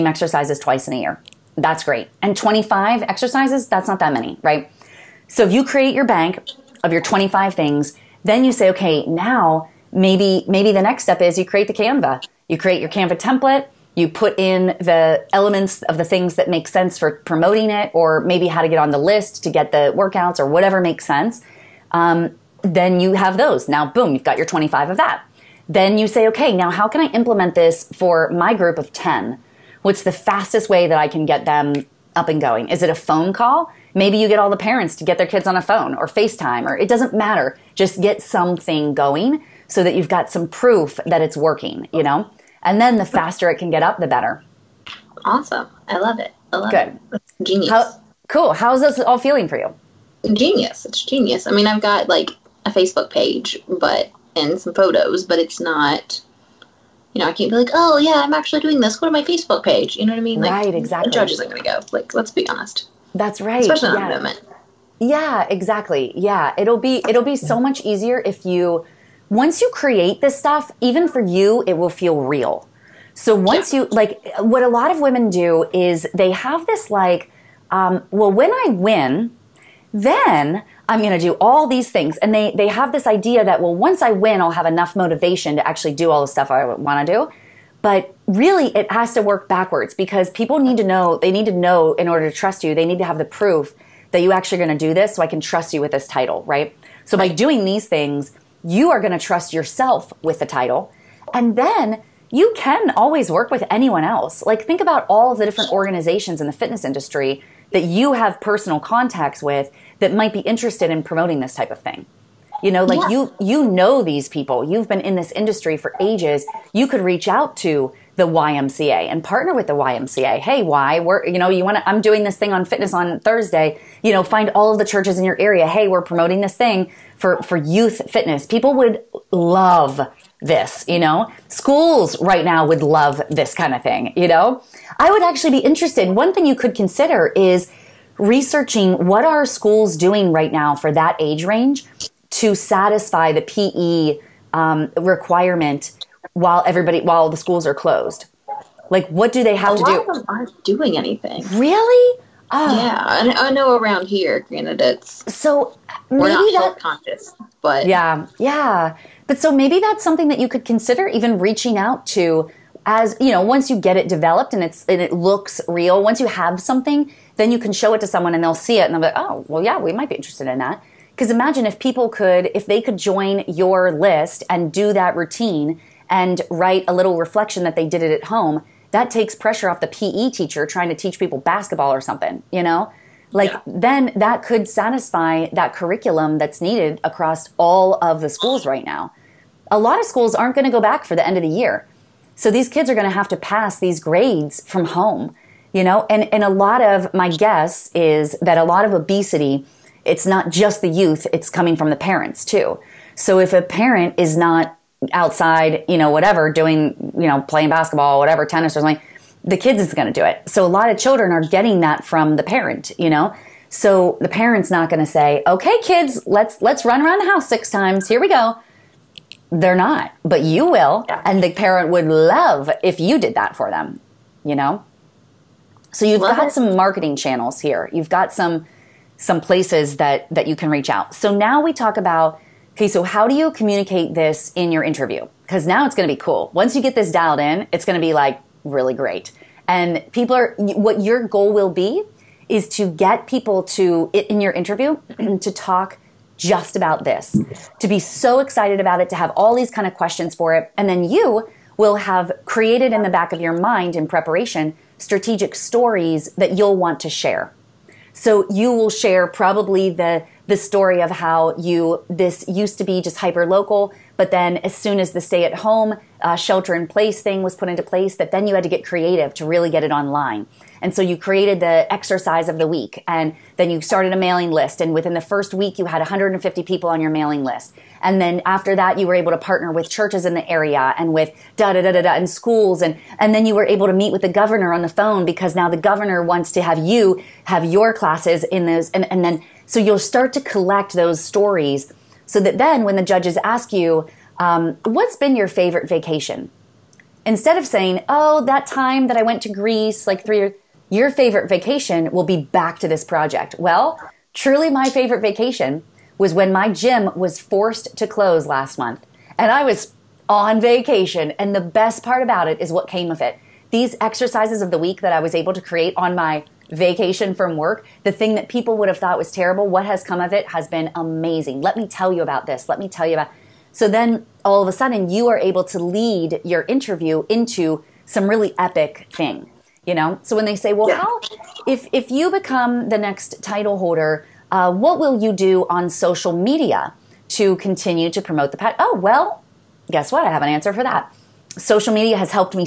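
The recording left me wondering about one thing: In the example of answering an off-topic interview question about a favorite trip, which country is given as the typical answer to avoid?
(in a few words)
Greece.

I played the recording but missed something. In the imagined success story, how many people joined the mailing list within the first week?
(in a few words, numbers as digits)
150.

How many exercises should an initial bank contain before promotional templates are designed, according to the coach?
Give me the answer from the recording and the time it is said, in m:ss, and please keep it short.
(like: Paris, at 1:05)
25, at 0:02.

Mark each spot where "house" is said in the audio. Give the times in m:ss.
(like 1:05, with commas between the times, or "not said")
3:37.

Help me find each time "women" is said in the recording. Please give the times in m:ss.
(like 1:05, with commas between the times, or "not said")
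1:14.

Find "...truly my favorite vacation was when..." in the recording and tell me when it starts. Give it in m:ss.
5:04.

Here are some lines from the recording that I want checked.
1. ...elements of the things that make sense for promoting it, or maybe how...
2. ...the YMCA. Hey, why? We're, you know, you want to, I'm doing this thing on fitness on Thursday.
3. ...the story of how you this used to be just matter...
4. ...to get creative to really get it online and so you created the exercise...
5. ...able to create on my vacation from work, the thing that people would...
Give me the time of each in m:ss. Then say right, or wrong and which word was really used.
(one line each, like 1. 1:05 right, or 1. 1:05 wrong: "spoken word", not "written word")
1. 0:15 right
2. 1:59 right
3. 4:20 wrong: "hyper", not "matter"
4. 4:28 right
5. 5:15 right.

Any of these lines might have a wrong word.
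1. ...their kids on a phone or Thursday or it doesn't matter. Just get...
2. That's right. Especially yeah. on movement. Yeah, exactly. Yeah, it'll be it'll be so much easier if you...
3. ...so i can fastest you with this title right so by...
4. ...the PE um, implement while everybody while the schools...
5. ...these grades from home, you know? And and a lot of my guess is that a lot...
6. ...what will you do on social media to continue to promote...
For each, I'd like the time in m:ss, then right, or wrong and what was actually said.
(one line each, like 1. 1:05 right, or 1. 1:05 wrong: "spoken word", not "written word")
1. 0:35 wrong: "FaceTime", not "Thursday"
2. 1:03 right
3. 1:35 wrong: "trust", not "fastest"
4. 2:23 wrong: "requirement", not "implement"
5. 3:13 right
6. 5:34 right.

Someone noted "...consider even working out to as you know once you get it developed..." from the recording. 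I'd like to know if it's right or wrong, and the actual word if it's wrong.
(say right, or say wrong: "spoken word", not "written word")
wrong: "reaching", not "working".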